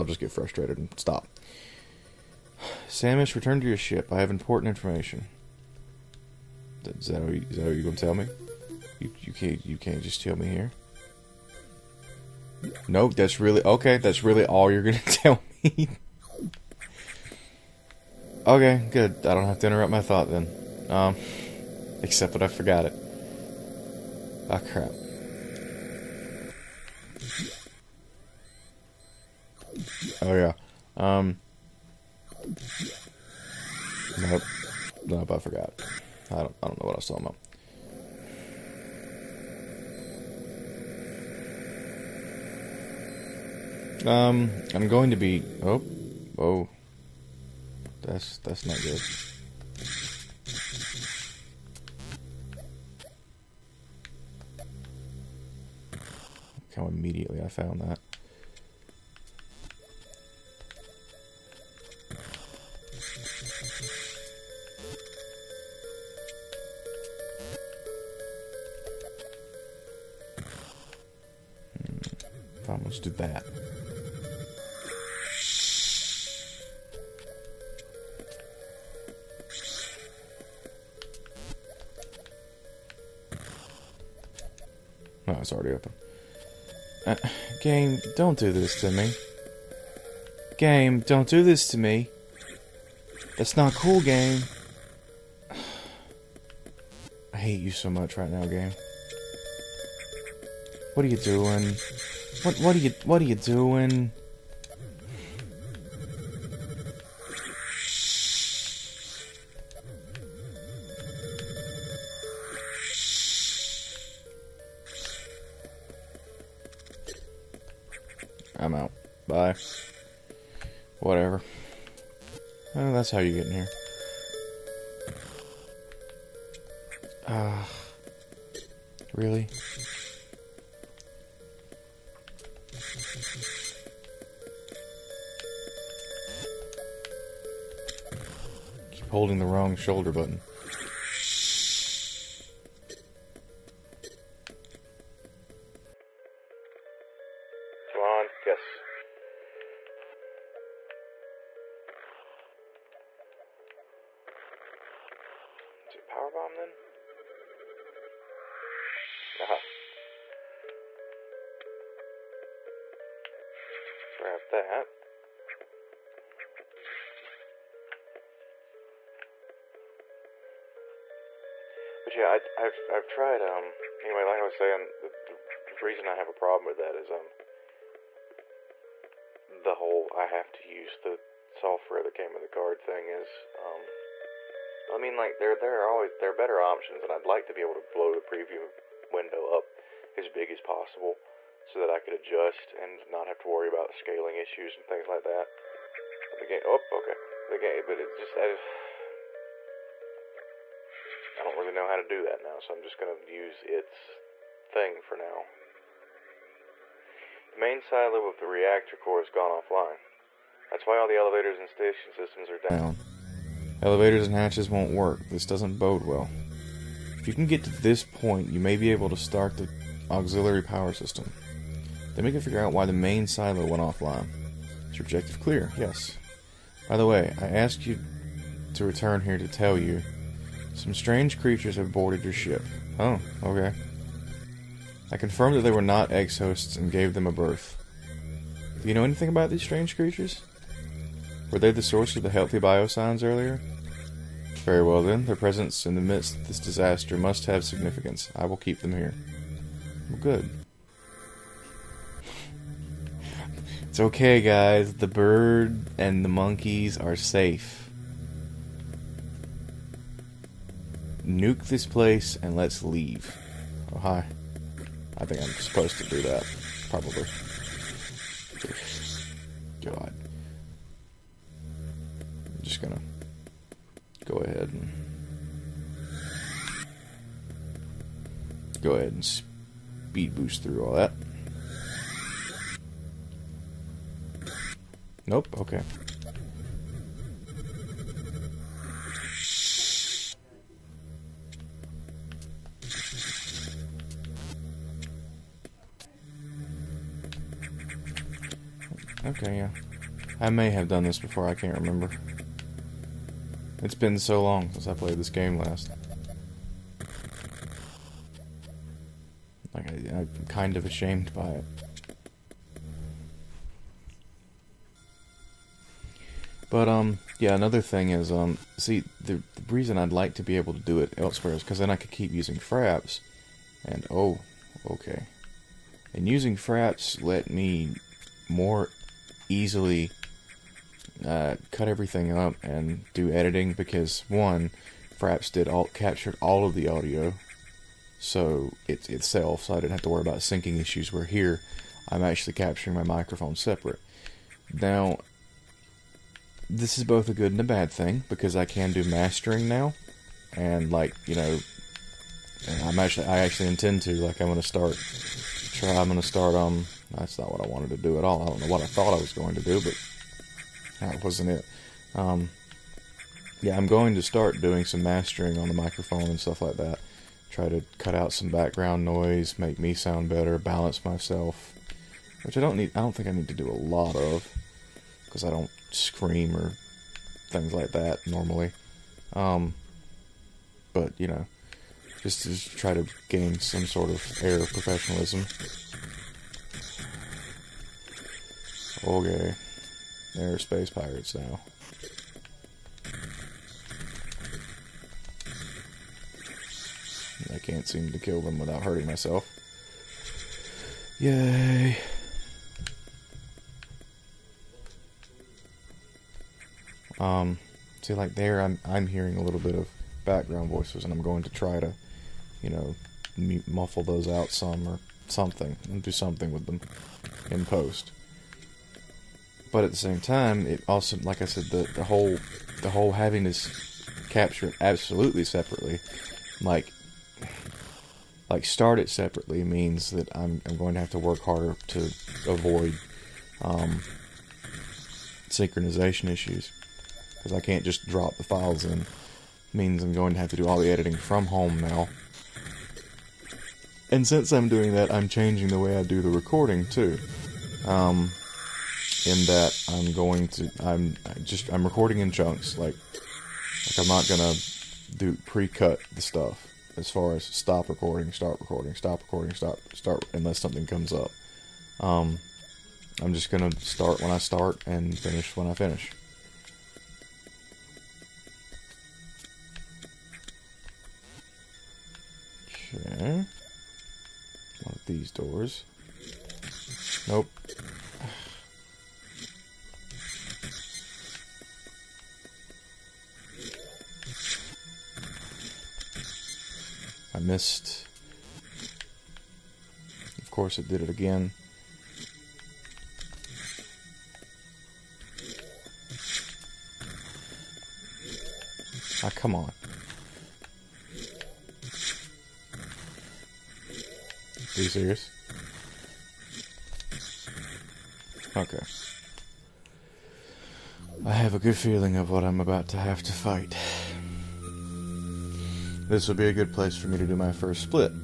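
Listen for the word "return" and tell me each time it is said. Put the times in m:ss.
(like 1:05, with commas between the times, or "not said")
0:03, 3:48.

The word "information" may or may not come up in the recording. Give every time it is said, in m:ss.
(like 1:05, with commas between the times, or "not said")
0:04.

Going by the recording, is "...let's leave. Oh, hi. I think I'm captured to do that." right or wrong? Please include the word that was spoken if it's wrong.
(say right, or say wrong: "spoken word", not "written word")
wrong: "supposed", not "captured".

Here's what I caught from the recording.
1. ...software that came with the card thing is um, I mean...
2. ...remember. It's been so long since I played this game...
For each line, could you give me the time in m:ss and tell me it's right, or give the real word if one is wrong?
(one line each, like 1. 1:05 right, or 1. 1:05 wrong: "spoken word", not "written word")
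1. 3:01 right
2. 5:01 right.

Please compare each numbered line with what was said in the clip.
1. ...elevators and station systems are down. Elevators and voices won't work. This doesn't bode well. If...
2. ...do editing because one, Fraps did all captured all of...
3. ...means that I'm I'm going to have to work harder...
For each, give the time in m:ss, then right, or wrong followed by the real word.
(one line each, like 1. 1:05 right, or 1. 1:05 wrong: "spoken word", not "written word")
1. 3:31 wrong: "hatches", not "voices"
2. 5:33 right
3. 7:09 right.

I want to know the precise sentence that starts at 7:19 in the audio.
means I'm going to have to do all the editing from home now.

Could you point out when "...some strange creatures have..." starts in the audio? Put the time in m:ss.
3:50.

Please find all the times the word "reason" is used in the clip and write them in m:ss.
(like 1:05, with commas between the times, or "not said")
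2:55, 5:19.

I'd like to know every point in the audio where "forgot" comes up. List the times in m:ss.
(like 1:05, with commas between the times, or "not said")
0:22, 0:35.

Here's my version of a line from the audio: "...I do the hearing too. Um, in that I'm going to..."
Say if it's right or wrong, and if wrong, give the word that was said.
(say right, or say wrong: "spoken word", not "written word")
wrong: "recording", not "hearing".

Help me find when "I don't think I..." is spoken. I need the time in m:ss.
6:12.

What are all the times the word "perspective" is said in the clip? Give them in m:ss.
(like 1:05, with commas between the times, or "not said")
not said.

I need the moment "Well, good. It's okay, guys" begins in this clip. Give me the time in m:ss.
4:10.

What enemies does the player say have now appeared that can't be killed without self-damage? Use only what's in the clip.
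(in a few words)
Space pirates.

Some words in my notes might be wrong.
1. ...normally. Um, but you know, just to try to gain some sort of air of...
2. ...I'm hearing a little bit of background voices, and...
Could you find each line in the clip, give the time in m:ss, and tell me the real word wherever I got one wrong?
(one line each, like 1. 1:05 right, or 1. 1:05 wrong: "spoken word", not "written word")
1. 6:18 right
2. 6:48 right.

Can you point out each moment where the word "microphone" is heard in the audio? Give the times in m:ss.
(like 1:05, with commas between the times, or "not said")
5:43, 6:05.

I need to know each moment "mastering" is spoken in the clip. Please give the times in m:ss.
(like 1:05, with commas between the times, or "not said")
5:49, 6:05.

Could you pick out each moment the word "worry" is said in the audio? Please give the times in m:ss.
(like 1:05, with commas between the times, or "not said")
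3:13, 5:40.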